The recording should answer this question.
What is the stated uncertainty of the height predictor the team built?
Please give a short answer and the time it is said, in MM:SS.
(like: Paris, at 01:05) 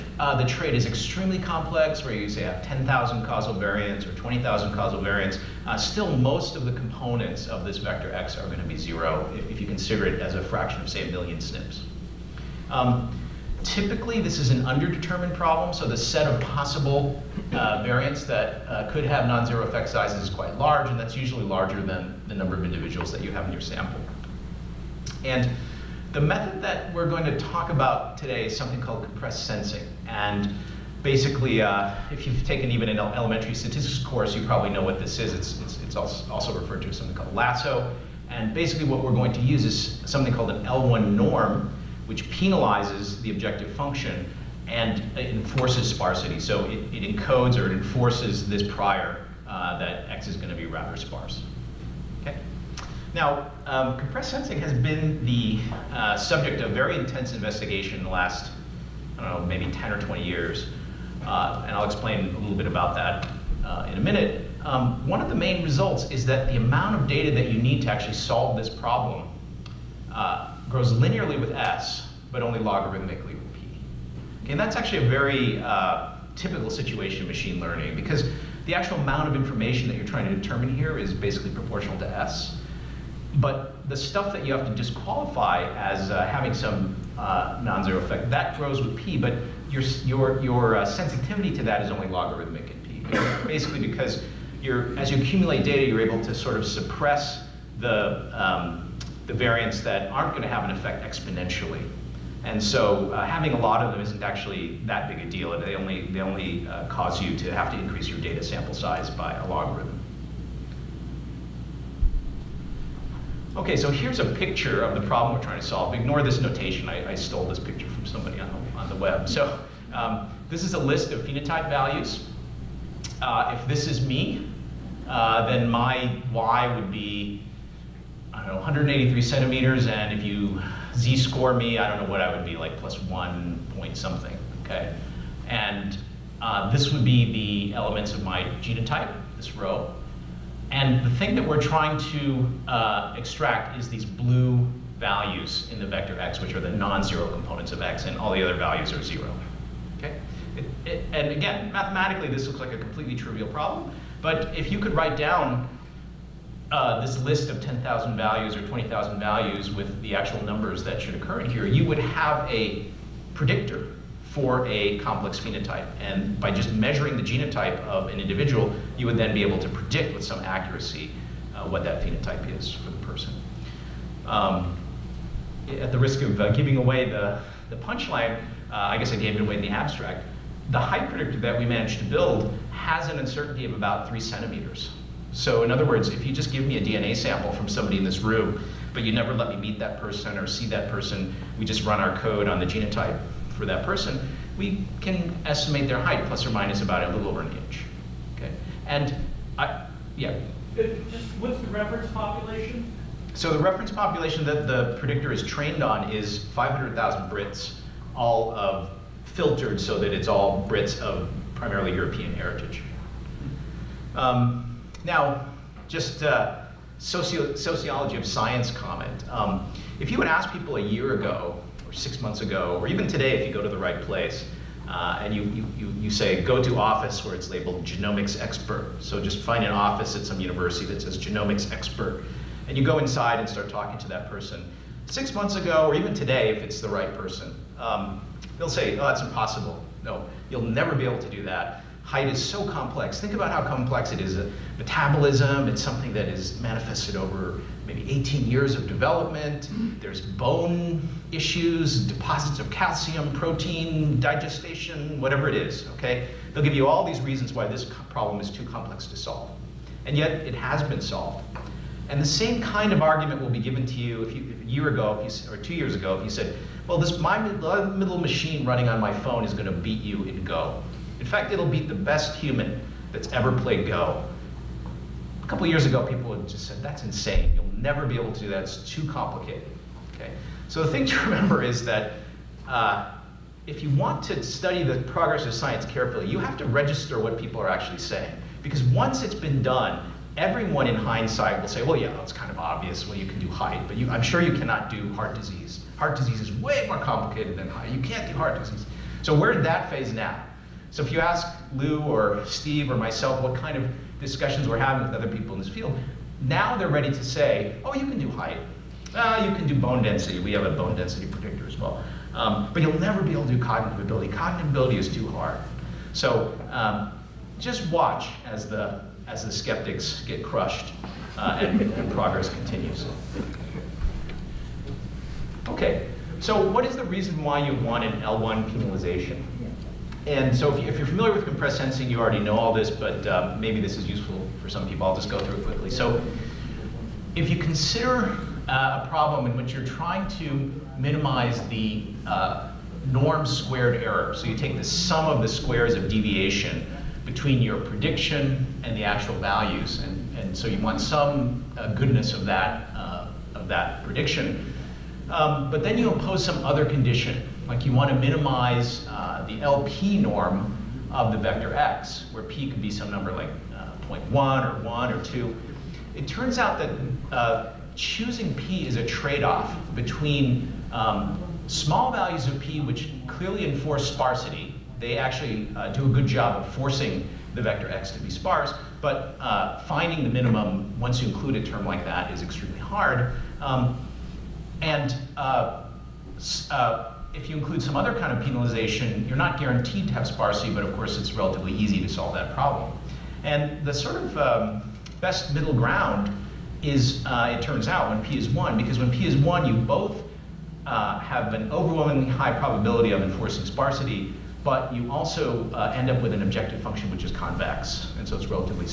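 about three centimeters, at 03:03.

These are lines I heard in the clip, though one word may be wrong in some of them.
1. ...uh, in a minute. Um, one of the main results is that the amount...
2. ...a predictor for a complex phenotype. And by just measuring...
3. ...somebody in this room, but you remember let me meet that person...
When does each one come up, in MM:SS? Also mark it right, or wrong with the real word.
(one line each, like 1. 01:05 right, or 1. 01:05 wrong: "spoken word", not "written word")
1. 01:03 right
2. 02:42 right
3. 03:07 wrong: "never", not "remember".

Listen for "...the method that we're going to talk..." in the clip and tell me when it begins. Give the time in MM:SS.
00:26.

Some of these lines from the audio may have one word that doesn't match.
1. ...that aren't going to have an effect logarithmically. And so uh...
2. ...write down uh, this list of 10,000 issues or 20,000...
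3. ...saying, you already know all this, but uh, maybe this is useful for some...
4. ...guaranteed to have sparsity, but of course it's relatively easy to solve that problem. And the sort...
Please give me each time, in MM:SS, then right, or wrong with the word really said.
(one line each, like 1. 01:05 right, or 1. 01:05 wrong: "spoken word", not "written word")
1. 01:39 wrong: "exponentially", not "logarithmically"
2. 02:34 wrong: "values", not "issues"
3. 05:31 wrong: "sensing", not "saying"
4. 06:29 right.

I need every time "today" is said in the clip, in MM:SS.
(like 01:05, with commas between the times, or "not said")
00:28, 03:43, 03:56.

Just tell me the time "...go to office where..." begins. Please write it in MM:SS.
03:46.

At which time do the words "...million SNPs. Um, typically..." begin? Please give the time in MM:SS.
00:11.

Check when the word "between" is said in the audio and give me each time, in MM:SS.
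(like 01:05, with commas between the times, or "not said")
05:47, 06:09.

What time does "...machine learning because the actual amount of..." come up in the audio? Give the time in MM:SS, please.
01:17.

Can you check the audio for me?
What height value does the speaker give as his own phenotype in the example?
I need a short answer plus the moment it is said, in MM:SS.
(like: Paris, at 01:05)
183 centimeters, at 02:08.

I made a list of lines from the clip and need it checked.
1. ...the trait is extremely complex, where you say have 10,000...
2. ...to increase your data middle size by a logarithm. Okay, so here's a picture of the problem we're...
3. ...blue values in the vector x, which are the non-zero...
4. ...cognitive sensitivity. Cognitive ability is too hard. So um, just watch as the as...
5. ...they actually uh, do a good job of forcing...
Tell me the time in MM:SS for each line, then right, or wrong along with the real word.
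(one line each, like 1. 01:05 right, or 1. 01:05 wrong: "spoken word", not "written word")
1. 00:00 right
2. 01:47 wrong: "sample", not "middle"
3. 02:24 right
4. 05:13 wrong: "ability", not "sensitivity"
5. 06:14 right.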